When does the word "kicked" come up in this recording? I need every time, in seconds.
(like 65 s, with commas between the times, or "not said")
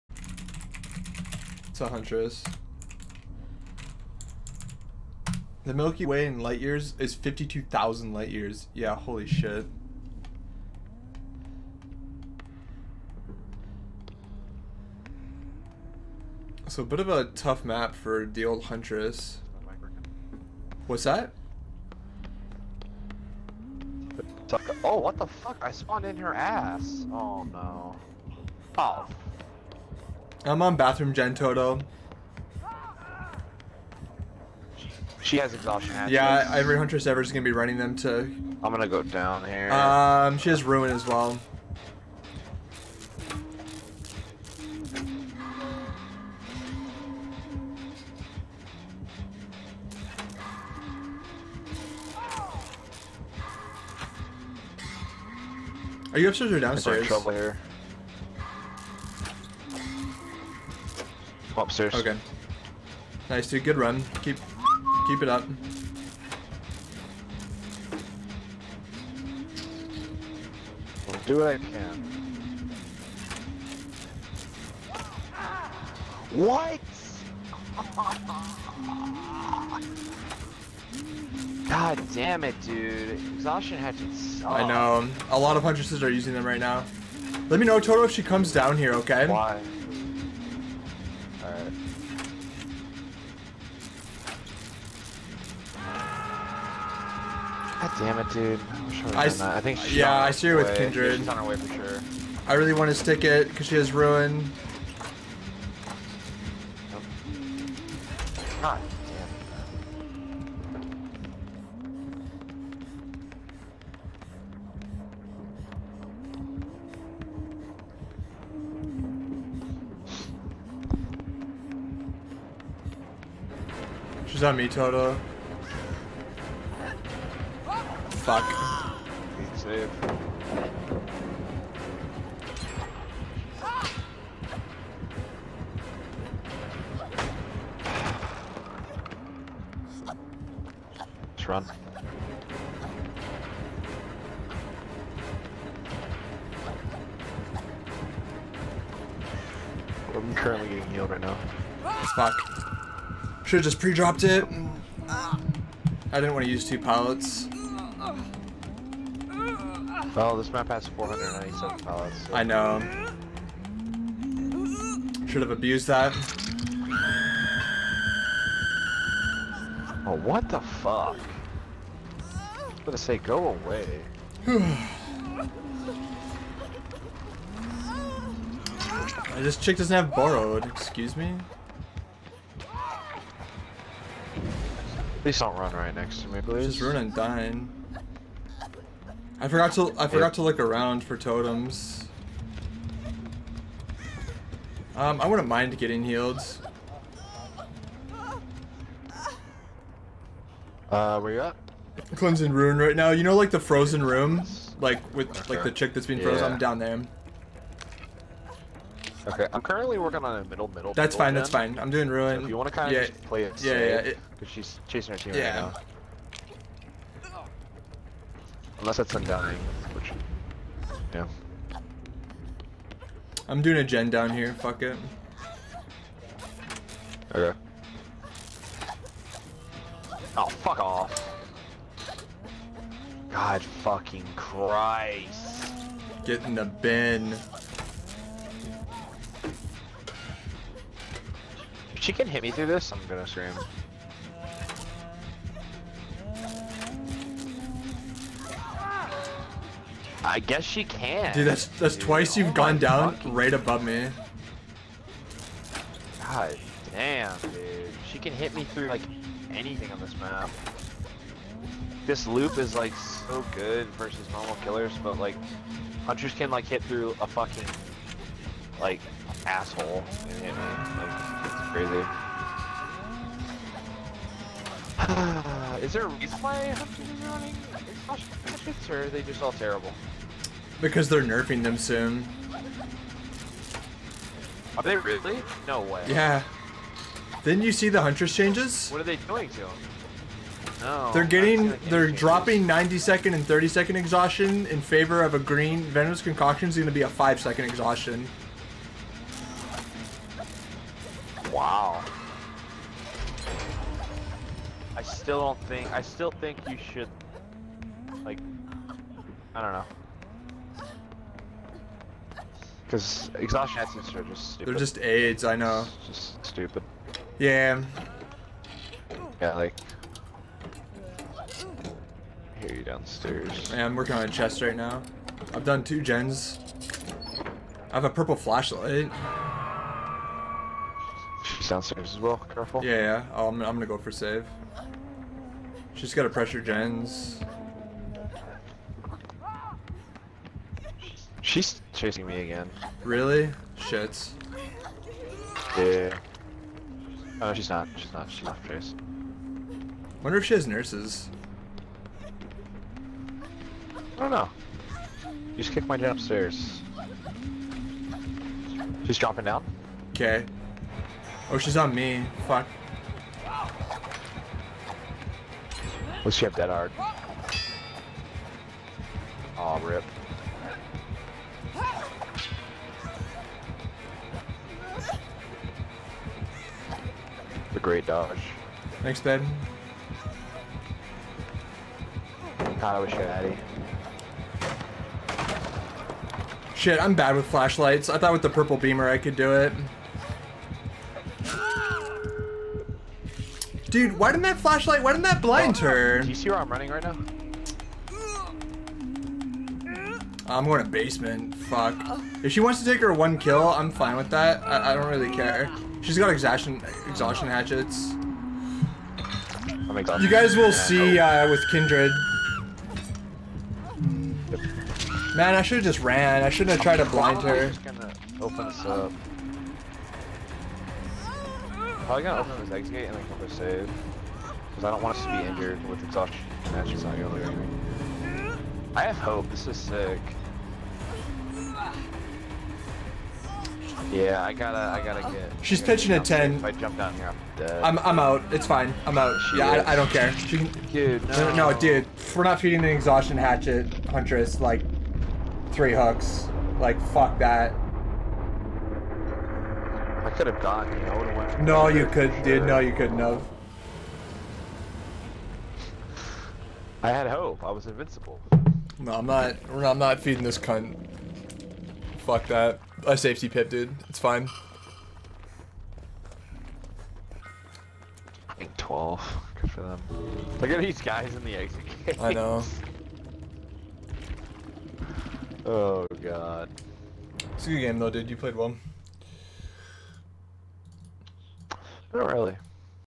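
355 s.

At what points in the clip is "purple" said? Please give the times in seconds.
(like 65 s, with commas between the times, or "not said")
328 s, 388 s.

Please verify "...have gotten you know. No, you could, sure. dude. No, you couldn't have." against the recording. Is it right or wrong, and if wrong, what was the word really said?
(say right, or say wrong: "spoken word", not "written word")
right.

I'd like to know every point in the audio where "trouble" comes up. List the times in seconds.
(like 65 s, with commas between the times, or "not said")
57 s.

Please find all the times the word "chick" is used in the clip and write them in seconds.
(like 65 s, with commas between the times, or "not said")
179 s, 205 s.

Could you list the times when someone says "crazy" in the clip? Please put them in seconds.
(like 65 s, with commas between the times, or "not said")
271 s.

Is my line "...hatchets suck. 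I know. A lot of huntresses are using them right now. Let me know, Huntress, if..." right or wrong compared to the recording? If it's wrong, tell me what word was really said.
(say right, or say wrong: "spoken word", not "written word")
wrong: "Toto", not "Huntress".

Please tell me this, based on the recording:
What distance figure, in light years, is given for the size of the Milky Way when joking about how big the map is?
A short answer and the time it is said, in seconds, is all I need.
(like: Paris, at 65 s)
52,000 light years, at 7 s.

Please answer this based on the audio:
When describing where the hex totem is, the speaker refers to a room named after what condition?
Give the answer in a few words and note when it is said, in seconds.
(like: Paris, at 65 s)
frozen room, at 203 s.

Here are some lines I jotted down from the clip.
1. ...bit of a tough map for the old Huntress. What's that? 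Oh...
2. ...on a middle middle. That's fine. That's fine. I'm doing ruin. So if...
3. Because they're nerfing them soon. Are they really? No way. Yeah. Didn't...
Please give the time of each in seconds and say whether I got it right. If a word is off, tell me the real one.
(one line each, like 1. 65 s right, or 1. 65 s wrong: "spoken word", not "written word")
1. 16 s right
2. 210 s right
3. 280 s right.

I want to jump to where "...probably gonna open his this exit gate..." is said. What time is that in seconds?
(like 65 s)
422 s.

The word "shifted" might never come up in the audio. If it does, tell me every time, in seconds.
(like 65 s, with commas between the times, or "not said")
not said.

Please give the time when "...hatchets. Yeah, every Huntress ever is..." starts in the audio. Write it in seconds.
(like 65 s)
35 s.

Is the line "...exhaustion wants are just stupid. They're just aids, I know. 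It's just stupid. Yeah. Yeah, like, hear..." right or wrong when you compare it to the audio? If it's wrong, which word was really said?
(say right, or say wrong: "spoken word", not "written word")
wrong: "assets", not "wants".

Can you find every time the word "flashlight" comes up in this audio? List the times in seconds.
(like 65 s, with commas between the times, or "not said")
328 s, 387 s, 394 s.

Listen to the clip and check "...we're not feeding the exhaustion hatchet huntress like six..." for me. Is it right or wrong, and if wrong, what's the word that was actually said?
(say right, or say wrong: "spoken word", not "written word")
wrong: "three", not "six".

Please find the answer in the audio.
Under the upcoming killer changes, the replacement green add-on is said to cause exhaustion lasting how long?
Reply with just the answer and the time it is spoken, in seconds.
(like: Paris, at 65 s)
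5 seconds, at 297 s.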